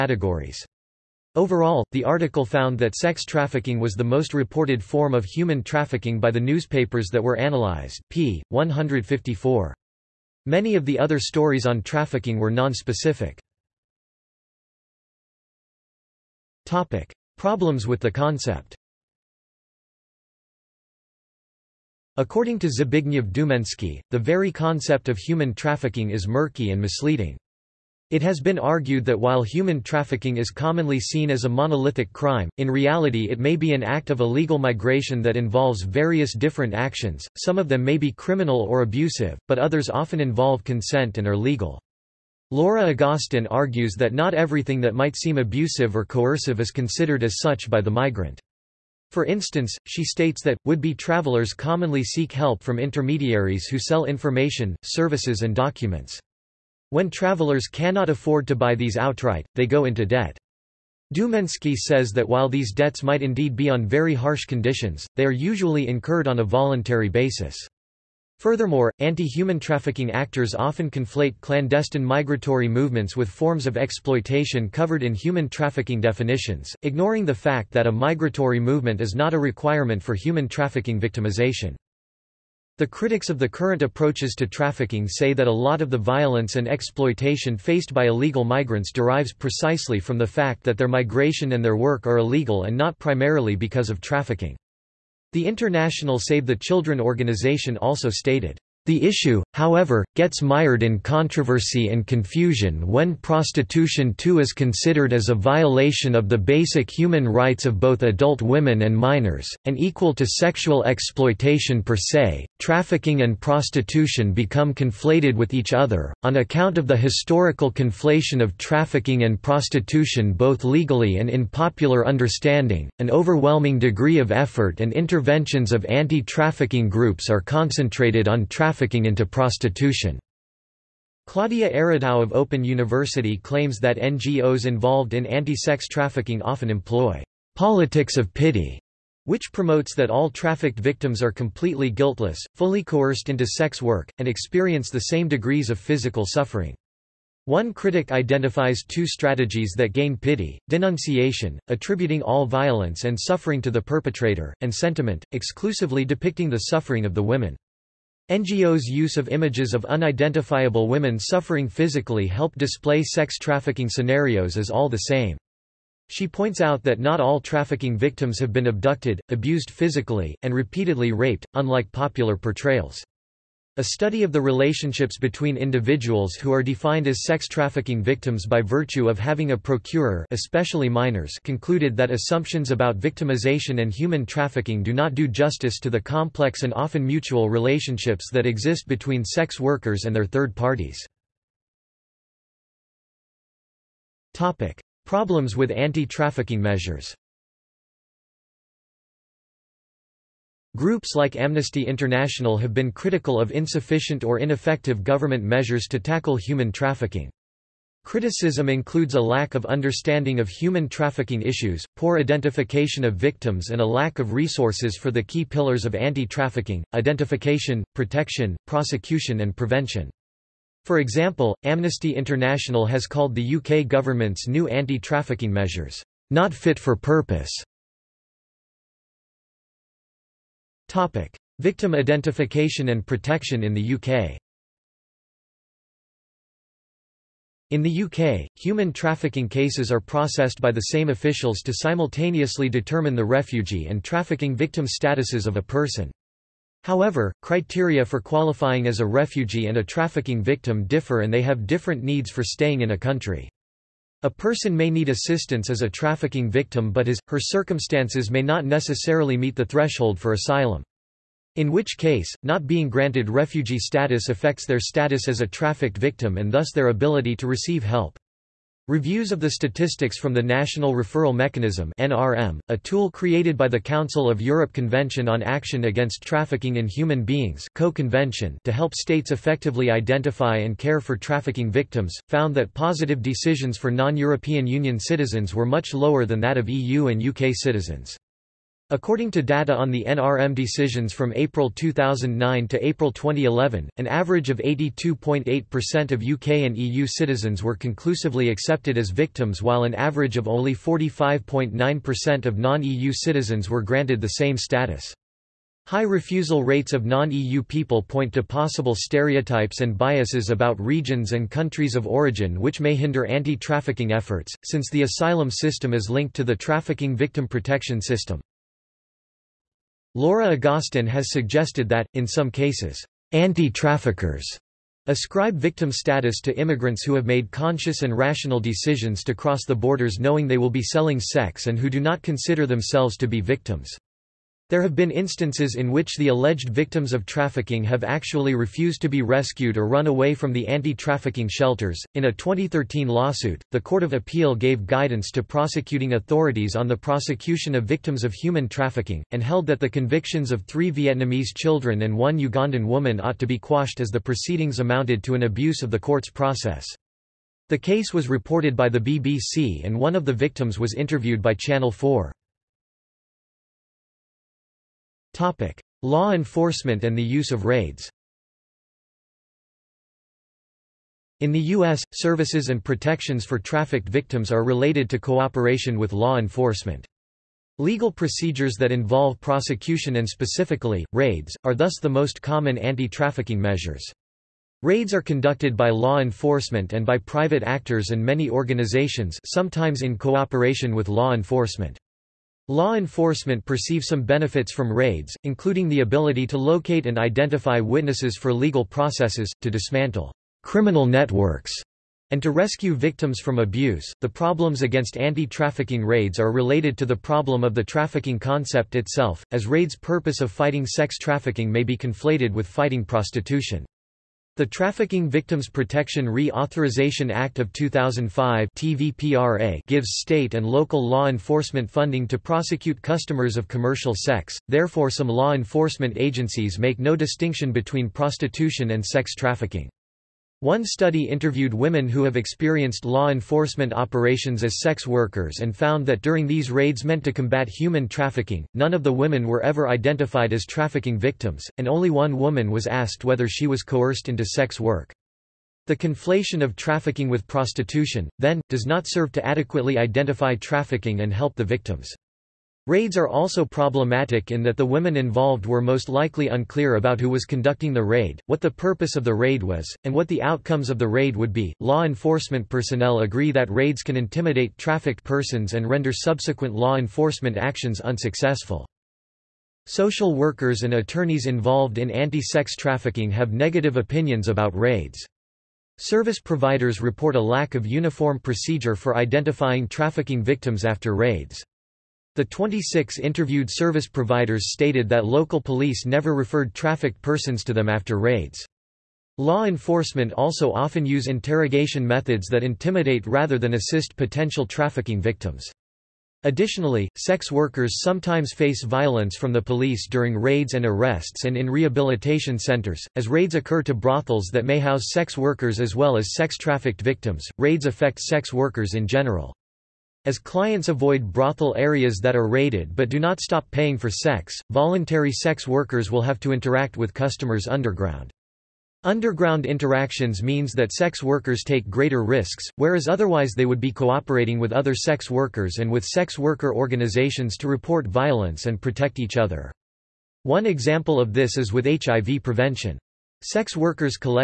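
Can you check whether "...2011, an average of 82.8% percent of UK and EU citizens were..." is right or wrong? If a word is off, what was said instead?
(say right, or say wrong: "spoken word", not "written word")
right.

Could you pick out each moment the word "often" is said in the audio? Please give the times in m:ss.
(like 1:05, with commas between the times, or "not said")
0:39, 1:10, 2:16, 3:06, 8:10.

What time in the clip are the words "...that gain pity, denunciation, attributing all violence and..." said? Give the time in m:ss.
2:29.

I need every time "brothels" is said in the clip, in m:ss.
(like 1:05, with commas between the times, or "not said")
8:23, 8:31.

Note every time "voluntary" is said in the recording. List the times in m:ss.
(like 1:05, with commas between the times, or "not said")
1:06, 8:34.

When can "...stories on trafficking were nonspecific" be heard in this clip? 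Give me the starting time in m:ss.
0:11.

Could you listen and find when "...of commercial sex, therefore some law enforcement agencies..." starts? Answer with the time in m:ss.
7:03.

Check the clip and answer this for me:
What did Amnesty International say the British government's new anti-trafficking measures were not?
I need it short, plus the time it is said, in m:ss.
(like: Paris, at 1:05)
fit for purpose, at 3:46.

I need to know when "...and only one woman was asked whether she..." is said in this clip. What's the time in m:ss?
7:21.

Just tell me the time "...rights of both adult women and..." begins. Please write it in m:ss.
1:47.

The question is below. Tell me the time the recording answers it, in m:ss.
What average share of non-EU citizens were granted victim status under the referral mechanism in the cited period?
5:00.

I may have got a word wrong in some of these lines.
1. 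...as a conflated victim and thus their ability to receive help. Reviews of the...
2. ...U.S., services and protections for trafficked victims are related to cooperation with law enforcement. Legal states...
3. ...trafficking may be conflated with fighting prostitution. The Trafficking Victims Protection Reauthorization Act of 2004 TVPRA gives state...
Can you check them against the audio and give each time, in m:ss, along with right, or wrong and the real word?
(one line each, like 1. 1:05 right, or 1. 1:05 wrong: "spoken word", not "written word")
1. 4:25 wrong: "trafficked", not "conflated"
2. 6:11 wrong: "procedures", not "states"
3. 6:51 wrong: "2005", not "2004".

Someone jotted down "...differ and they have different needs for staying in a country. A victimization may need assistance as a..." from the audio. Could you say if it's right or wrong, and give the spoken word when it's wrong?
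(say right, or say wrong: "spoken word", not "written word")
wrong: "person", not "victimization".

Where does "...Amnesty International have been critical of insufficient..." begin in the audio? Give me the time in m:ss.
3:21.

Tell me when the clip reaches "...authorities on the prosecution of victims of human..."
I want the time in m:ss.
5:46.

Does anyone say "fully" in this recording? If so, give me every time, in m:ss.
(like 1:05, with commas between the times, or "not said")
2:22.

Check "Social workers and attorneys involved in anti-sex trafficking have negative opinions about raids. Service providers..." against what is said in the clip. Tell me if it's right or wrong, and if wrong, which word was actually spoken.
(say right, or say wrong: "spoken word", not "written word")
right.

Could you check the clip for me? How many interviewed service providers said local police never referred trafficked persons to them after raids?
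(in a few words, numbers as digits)
26.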